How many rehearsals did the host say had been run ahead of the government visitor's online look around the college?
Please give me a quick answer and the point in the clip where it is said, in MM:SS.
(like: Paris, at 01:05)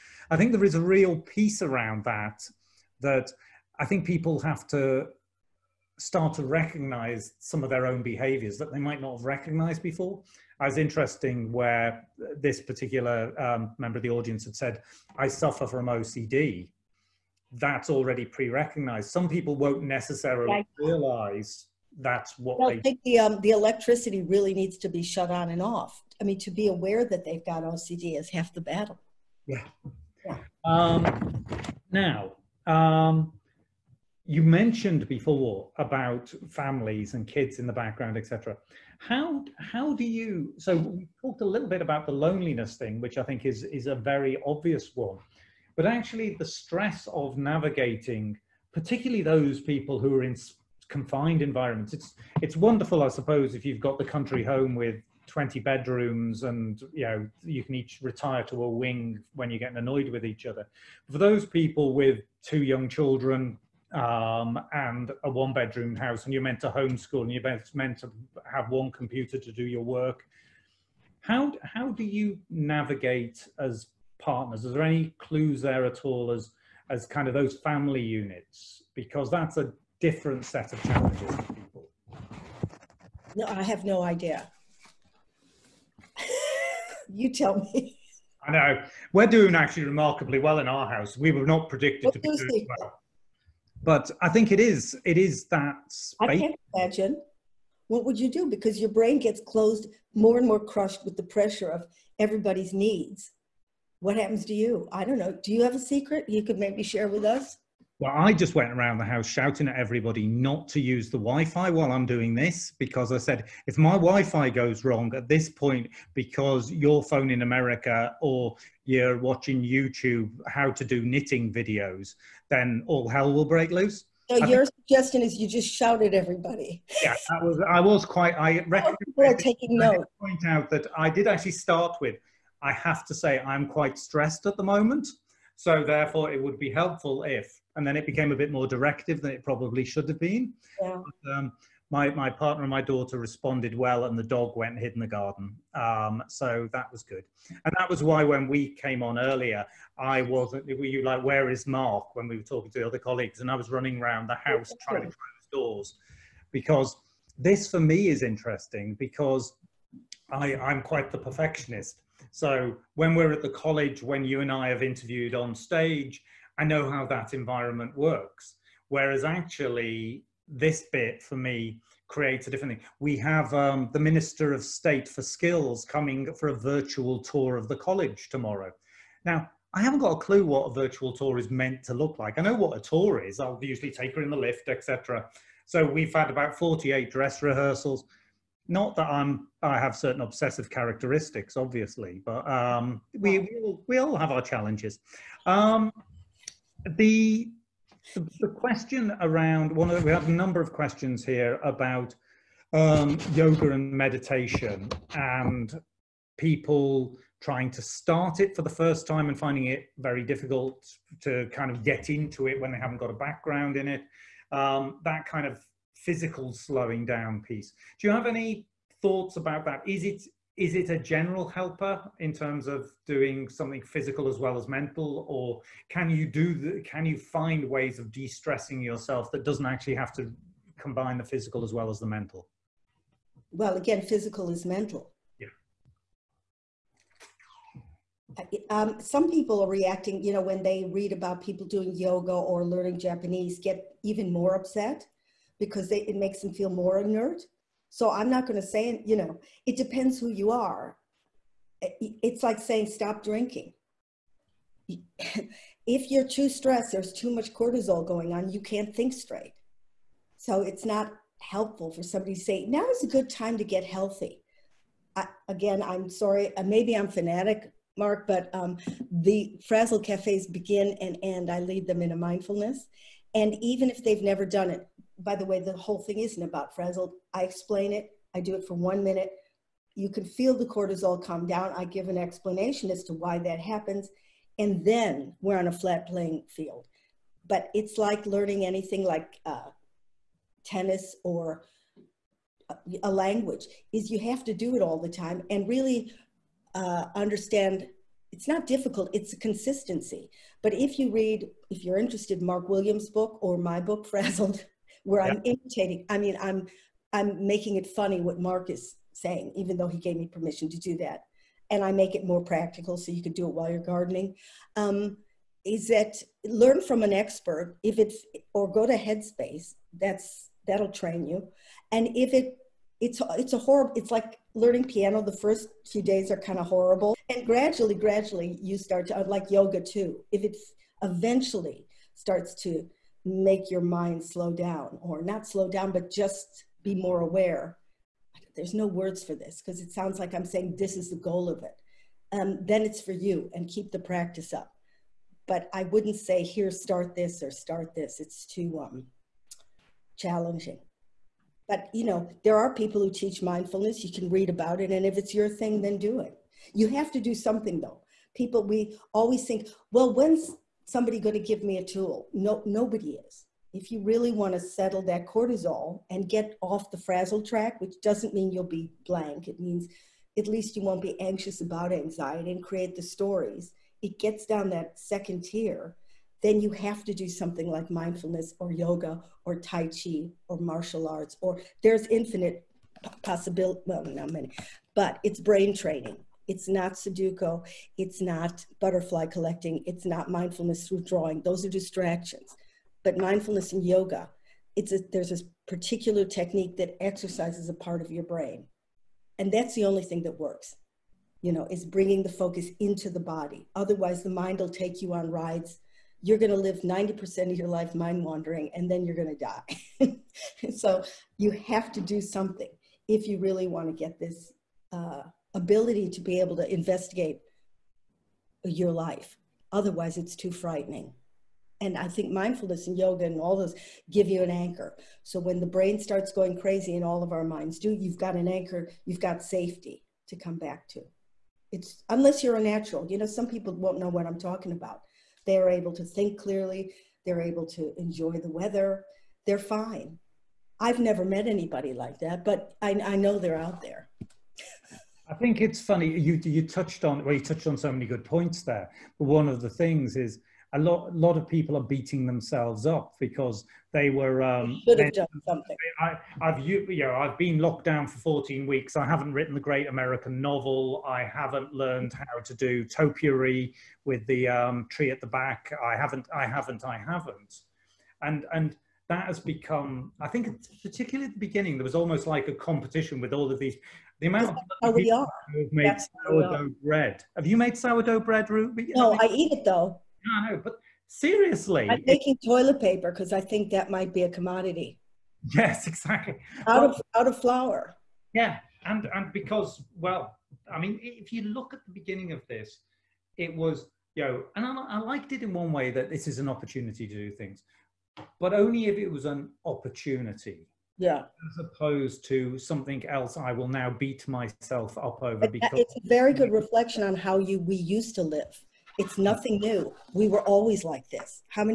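48, at 03:06.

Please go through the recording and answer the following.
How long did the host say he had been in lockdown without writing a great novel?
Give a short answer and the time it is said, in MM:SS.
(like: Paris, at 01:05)
14 weeks, at 07:38.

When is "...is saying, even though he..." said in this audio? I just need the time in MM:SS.
05:08.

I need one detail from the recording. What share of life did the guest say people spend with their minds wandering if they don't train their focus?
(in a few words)
90%.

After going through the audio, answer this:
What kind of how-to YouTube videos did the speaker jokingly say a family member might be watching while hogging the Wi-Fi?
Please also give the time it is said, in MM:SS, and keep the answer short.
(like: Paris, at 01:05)
knitting, at 02:01.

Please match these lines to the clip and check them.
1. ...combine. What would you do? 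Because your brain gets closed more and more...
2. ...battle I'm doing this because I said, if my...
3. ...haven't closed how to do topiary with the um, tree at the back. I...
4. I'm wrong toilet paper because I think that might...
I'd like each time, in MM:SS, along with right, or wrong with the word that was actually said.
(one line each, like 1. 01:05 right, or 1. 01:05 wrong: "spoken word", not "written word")
1. 01:36 wrong: "imagine", not "combine"
2. 01:51 wrong: "while", not "battle"
3. 07:41 wrong: "learned", not "closed"
4. 08:01 wrong: "making", not "wrong".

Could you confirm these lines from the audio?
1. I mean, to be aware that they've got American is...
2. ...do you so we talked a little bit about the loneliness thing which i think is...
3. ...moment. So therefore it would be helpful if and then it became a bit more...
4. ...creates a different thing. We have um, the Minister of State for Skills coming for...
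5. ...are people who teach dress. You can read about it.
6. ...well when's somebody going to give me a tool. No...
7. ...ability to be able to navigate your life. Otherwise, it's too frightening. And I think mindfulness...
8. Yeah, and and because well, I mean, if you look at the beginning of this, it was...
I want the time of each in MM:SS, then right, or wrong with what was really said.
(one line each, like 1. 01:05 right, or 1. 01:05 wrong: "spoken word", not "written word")
1. 00:26 wrong: "OCD", not "American"
2. 00:39 right
3. 02:14 right
4. 02:52 right
5. 05:52 wrong: "mindfulness", not "dress"
6. 05:59 right
7. 06:55 wrong: "investigate", not "navigate"
8. 08:08 right.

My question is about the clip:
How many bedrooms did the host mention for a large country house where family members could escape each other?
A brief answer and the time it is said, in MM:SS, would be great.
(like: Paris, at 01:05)
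20, at 00:55.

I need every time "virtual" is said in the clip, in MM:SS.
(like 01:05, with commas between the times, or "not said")
02:56, 03:00.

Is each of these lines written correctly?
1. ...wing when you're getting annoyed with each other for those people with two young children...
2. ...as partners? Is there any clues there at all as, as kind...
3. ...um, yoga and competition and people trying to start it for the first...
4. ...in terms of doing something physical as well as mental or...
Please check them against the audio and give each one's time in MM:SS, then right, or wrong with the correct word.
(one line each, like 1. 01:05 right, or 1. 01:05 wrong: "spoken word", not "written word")
1. 00:58 right
2. 01:13 right
3. 03:22 wrong: "meditation", not "competition"
4. 03:42 right.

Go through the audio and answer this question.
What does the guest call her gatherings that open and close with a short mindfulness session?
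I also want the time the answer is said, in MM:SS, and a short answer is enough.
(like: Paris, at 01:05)
Frazzle Cafes, at 04:29.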